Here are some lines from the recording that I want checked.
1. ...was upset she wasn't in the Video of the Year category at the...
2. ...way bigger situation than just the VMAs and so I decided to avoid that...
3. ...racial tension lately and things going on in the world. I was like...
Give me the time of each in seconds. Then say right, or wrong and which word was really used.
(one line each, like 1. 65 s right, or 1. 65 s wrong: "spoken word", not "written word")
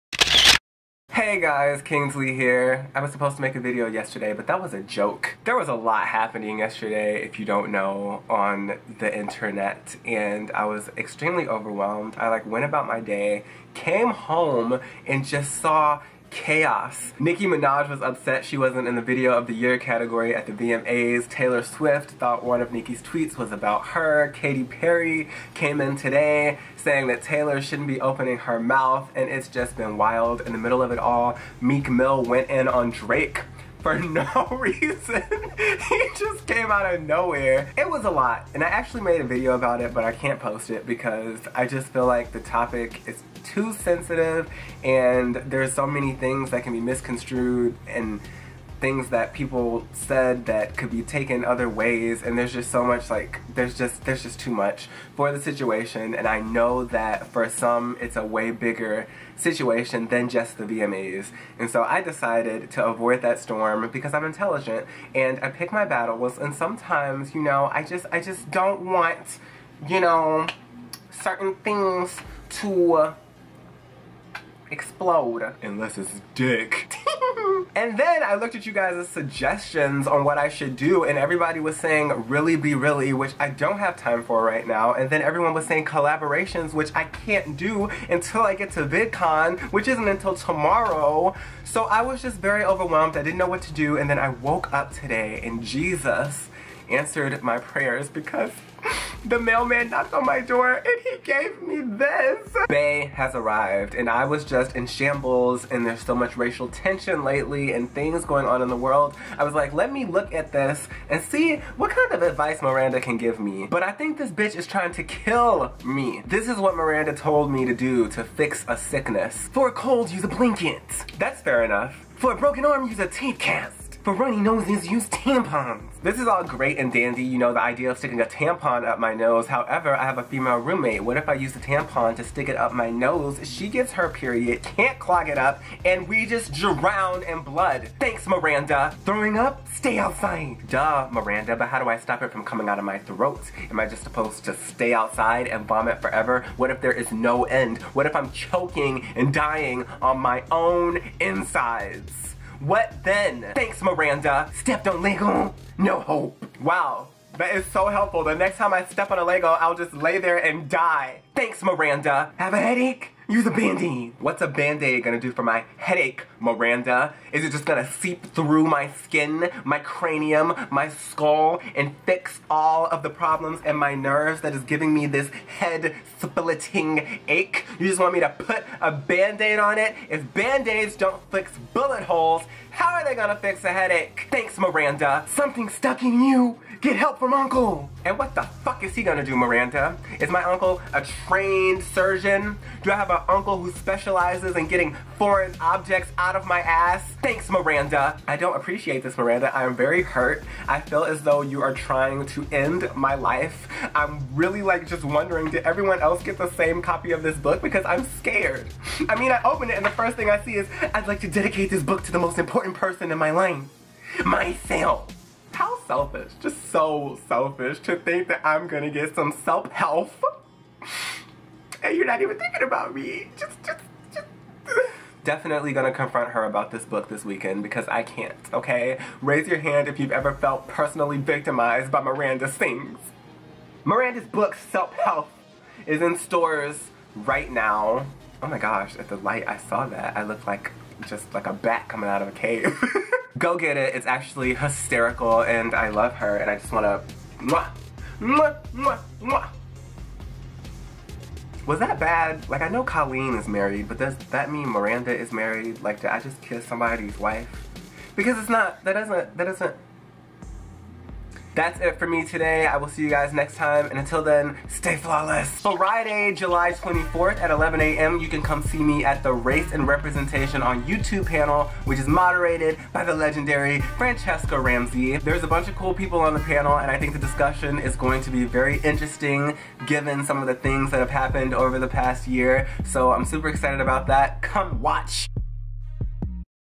1. 17 s right
2. 58 s right
3. 106 s right.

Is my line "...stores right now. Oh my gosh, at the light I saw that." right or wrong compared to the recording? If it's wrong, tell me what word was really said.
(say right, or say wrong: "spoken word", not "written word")
right.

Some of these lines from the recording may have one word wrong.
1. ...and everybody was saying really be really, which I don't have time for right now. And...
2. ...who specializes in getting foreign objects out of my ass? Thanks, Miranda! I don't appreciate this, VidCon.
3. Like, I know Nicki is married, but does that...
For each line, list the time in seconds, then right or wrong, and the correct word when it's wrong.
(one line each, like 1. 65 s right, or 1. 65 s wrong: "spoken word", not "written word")
1. 81 s right
2. 193 s wrong: "Miranda", not "VidCon"
3. 252 s wrong: "Colleen", not "Nicki".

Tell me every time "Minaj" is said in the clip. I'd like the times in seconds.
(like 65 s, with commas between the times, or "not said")
17 s.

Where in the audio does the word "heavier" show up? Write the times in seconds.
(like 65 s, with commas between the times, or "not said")
not said.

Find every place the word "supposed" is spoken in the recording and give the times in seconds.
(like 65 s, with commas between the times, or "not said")
3 s, 144 s.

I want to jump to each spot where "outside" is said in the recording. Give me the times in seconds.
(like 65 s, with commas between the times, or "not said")
139 s, 144 s.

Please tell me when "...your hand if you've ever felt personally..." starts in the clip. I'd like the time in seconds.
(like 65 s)
229 s.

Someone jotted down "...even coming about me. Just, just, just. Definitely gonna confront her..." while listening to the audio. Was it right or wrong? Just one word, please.
wrong.